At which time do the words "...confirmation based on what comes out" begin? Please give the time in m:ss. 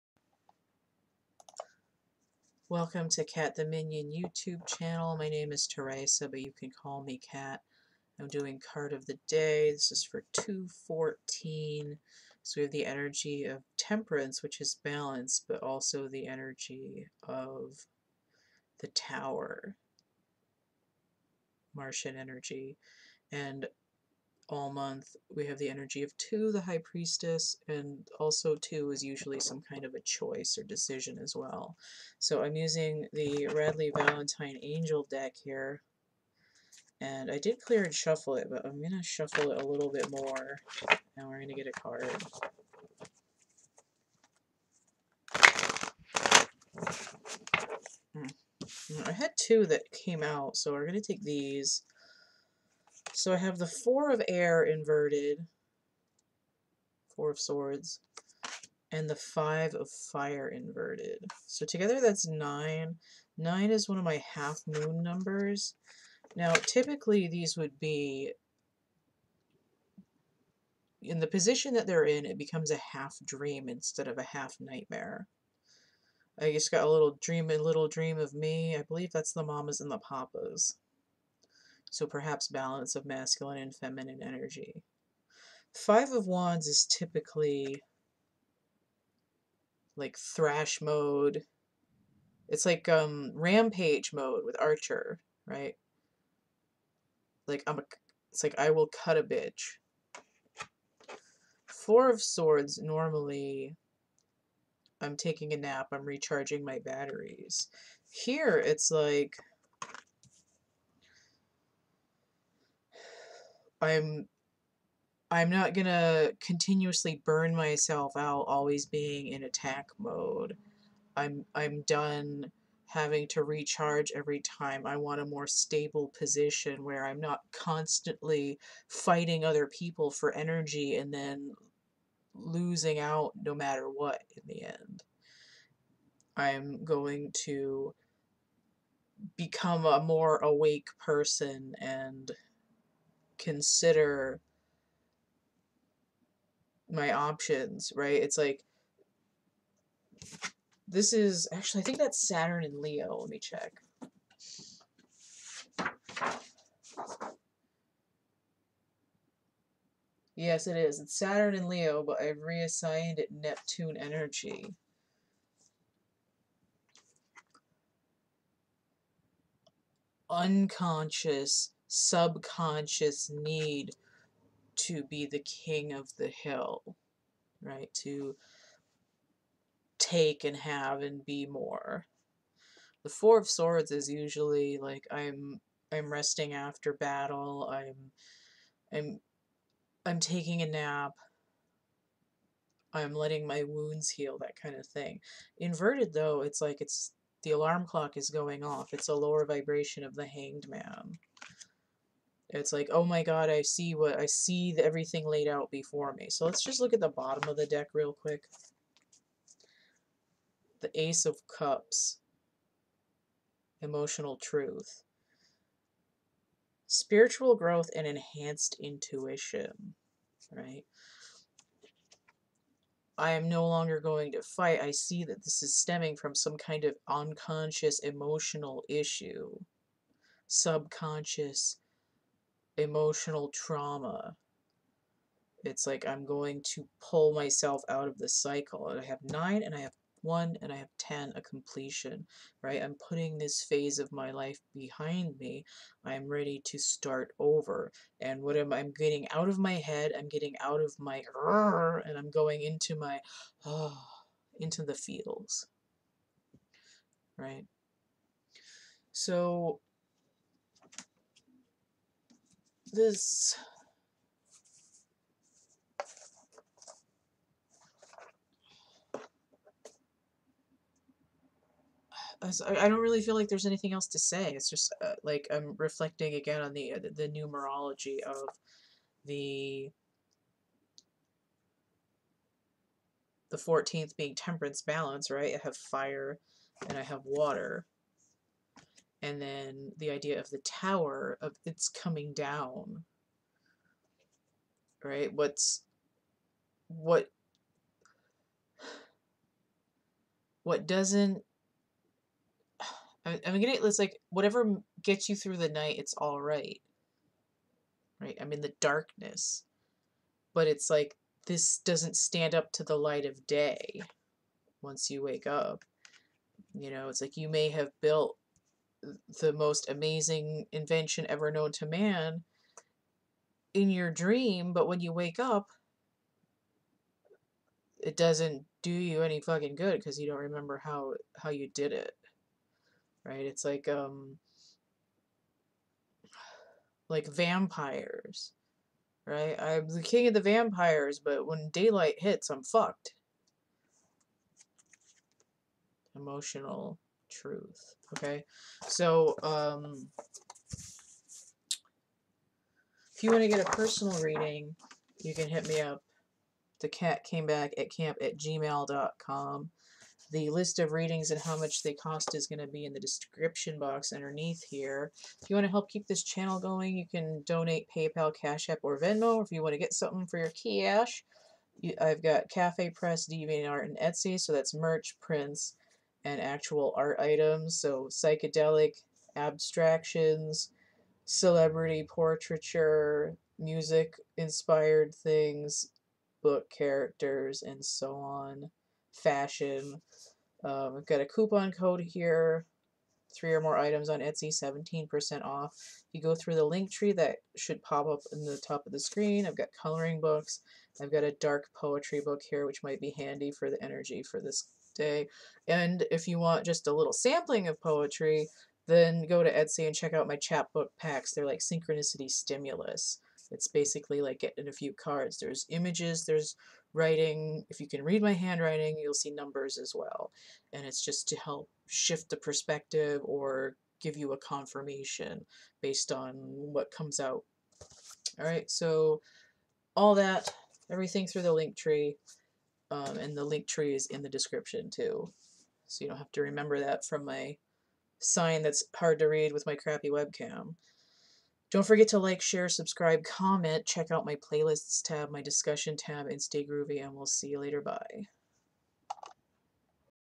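7:04.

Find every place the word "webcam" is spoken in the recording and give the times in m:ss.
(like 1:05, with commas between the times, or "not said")
7:20.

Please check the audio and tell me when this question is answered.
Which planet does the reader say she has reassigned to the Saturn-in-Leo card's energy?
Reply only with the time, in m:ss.
2:43.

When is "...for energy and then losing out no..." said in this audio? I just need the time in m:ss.
2:10.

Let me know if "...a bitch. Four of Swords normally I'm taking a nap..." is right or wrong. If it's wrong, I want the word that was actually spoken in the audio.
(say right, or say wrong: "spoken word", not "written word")
right.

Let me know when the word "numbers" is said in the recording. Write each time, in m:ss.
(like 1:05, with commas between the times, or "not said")
1:05, 6:59.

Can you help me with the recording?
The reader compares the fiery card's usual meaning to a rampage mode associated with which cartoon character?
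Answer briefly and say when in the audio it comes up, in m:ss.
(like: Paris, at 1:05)
Archer, at 1:34.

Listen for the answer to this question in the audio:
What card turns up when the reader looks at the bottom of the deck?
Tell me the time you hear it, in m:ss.
3:30.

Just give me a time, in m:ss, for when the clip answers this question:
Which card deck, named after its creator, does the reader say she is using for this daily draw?
0:33.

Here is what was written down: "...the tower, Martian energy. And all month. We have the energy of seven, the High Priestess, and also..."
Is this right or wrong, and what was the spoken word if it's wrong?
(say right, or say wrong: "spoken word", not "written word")
wrong: "two", not "seven".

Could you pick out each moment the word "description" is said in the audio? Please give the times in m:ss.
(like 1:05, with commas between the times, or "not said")
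6:03, 7:14.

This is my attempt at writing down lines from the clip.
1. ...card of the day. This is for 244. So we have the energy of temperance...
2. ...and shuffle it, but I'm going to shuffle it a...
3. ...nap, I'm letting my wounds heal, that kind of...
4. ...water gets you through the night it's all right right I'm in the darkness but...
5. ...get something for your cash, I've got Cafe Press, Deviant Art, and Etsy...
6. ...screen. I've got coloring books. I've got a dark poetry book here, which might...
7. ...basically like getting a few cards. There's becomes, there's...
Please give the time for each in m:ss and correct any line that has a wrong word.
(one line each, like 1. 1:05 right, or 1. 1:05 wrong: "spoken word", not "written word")
1. 0:08 wrong: "214", not "244"
2. 0:37 right
3. 3:10 right
4. 5:04 wrong: "whatever", not "water"
5. 6:09 right
6. 6:38 right
7. 6:53 wrong: "images", not "becomes".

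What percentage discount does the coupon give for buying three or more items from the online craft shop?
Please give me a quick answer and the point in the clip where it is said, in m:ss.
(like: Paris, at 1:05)
17%, at 6:34.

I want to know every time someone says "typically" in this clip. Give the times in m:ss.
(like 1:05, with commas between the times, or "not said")
1:06, 1:26.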